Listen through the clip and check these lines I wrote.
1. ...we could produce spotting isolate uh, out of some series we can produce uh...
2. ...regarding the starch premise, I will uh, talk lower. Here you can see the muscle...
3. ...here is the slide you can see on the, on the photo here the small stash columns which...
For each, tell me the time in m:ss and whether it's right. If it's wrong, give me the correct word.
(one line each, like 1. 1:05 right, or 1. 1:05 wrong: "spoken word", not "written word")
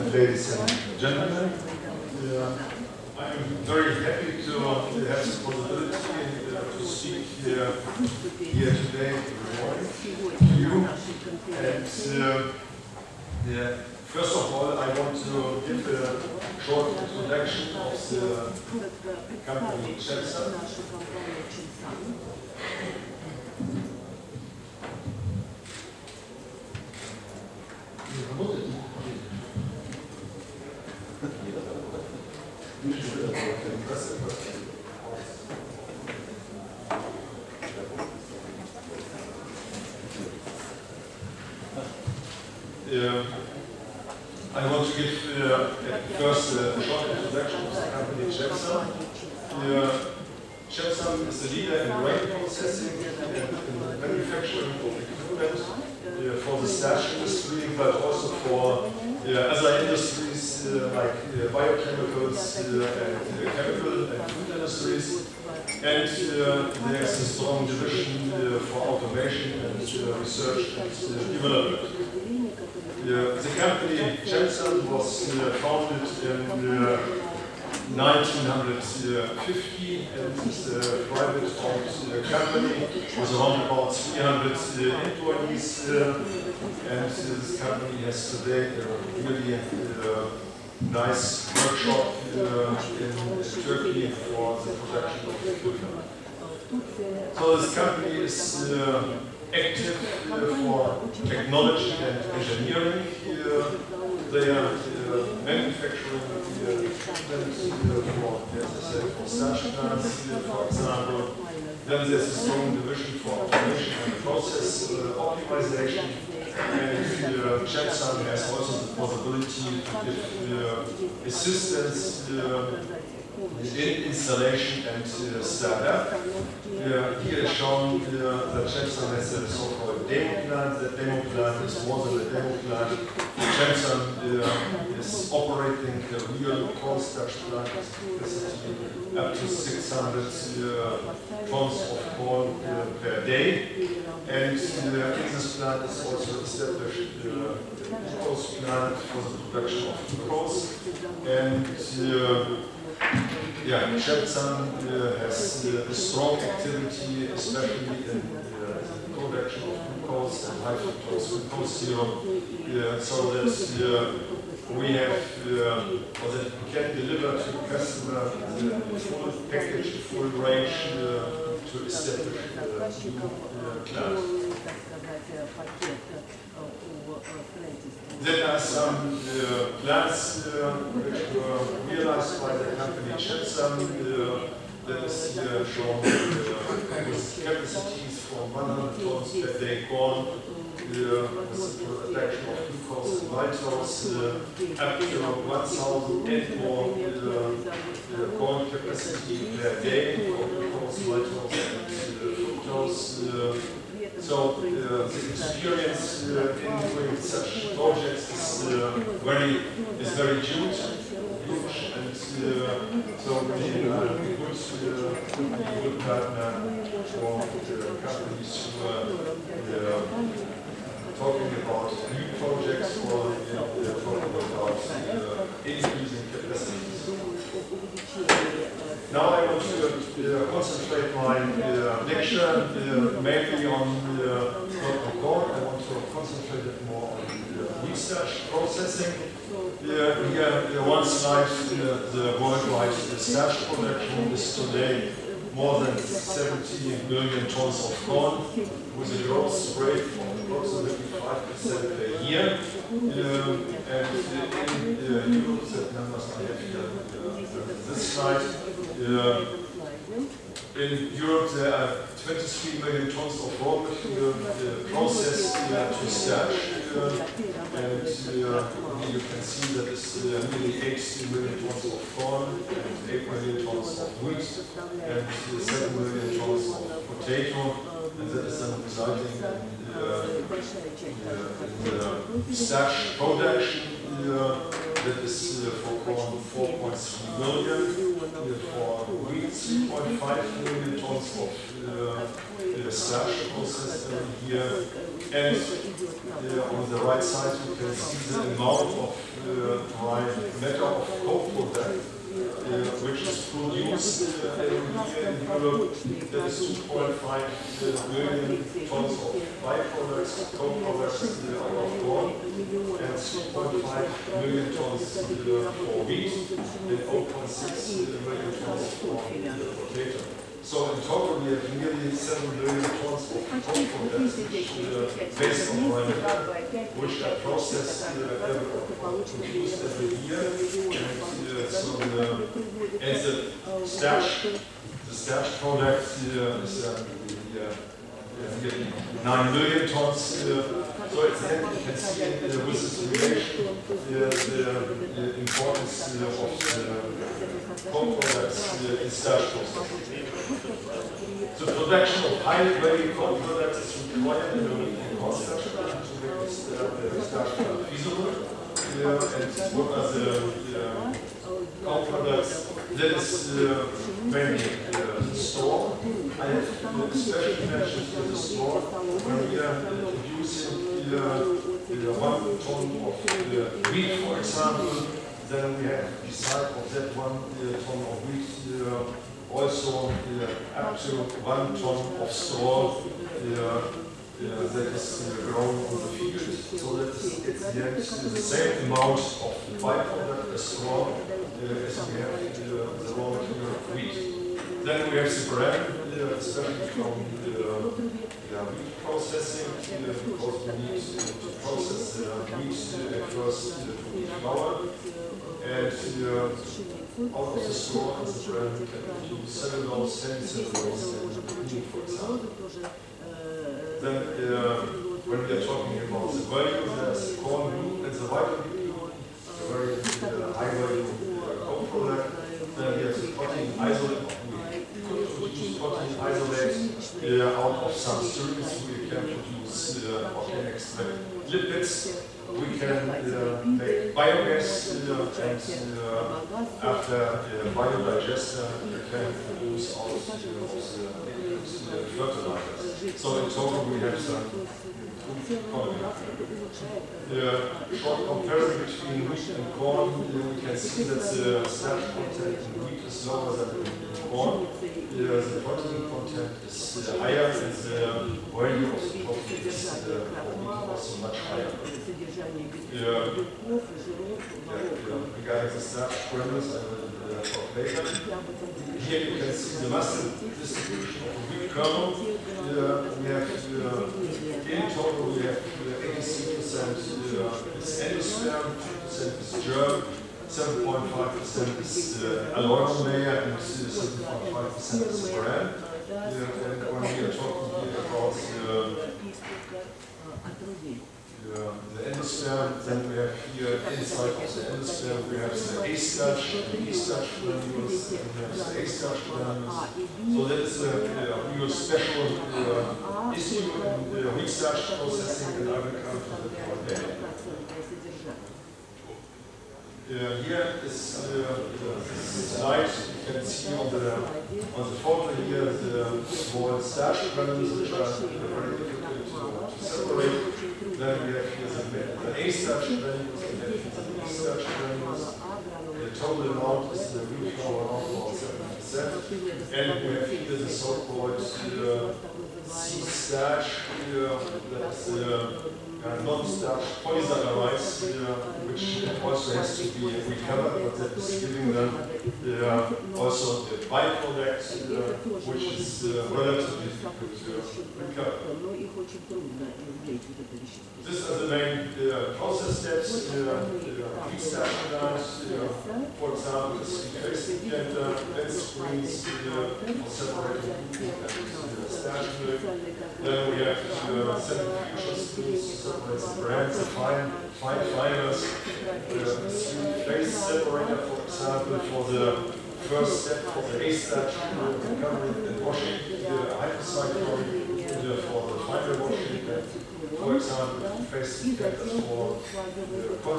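1. 7:04 right
2. 7:45 wrong: "later", not "lower"
3. 8:30 right.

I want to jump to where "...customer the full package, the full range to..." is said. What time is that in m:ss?
2:47.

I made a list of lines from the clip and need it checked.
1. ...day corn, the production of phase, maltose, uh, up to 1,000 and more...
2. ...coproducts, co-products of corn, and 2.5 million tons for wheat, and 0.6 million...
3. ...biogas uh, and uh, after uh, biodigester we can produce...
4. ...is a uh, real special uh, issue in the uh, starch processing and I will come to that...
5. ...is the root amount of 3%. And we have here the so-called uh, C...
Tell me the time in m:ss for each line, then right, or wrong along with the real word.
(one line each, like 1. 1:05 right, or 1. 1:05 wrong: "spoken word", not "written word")
1. 3:09 wrong: "glucose", not "phase"
2. 5:09 wrong: "byproducts", not "coproducts"
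3. 7:14 right
4. 8:20 right
5. 8:46 wrong: "7", not "3".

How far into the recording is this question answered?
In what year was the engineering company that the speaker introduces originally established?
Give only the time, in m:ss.
1:17.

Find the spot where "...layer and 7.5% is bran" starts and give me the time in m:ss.
8:03.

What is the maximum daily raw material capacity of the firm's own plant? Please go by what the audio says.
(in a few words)
600 tons.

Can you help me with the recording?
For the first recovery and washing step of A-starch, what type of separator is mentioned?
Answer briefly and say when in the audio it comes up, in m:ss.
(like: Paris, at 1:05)
three-phase separator, at 9:29.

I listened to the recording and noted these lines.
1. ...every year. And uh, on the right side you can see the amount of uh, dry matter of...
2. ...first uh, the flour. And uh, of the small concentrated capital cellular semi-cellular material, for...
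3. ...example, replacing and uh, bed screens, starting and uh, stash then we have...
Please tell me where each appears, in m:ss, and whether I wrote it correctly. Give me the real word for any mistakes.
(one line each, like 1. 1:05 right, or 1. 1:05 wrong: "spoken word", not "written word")
1. 4:54 right
2. 6:43 wrong: "capital", not "material"
3. 9:16 wrong: "separating", not "starting".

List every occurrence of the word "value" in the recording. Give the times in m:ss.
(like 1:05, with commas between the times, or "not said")
6:56, 7:00, 7:38.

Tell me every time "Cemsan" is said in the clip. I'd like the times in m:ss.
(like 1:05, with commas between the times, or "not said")
1:14, 2:13, 2:33, 3:03.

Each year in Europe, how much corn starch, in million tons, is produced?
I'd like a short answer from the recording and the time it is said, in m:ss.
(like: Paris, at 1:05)
4.3 million tons, at 4:46.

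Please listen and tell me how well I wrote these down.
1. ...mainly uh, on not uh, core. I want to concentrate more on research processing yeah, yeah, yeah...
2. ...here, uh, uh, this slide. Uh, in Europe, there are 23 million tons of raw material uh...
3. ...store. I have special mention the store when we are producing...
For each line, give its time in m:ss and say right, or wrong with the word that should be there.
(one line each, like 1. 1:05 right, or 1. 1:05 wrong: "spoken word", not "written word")
1. 3:53 right
2. 4:16 right
3. 6:05 right.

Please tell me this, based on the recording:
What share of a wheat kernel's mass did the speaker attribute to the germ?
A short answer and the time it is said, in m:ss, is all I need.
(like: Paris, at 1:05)
2%, at 7:58.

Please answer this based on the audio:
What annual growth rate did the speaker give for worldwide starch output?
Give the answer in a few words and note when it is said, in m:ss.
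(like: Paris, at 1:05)
5%, at 4:10.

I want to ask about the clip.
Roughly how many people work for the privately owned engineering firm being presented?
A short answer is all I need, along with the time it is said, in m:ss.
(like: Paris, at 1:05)
300, at 1:23.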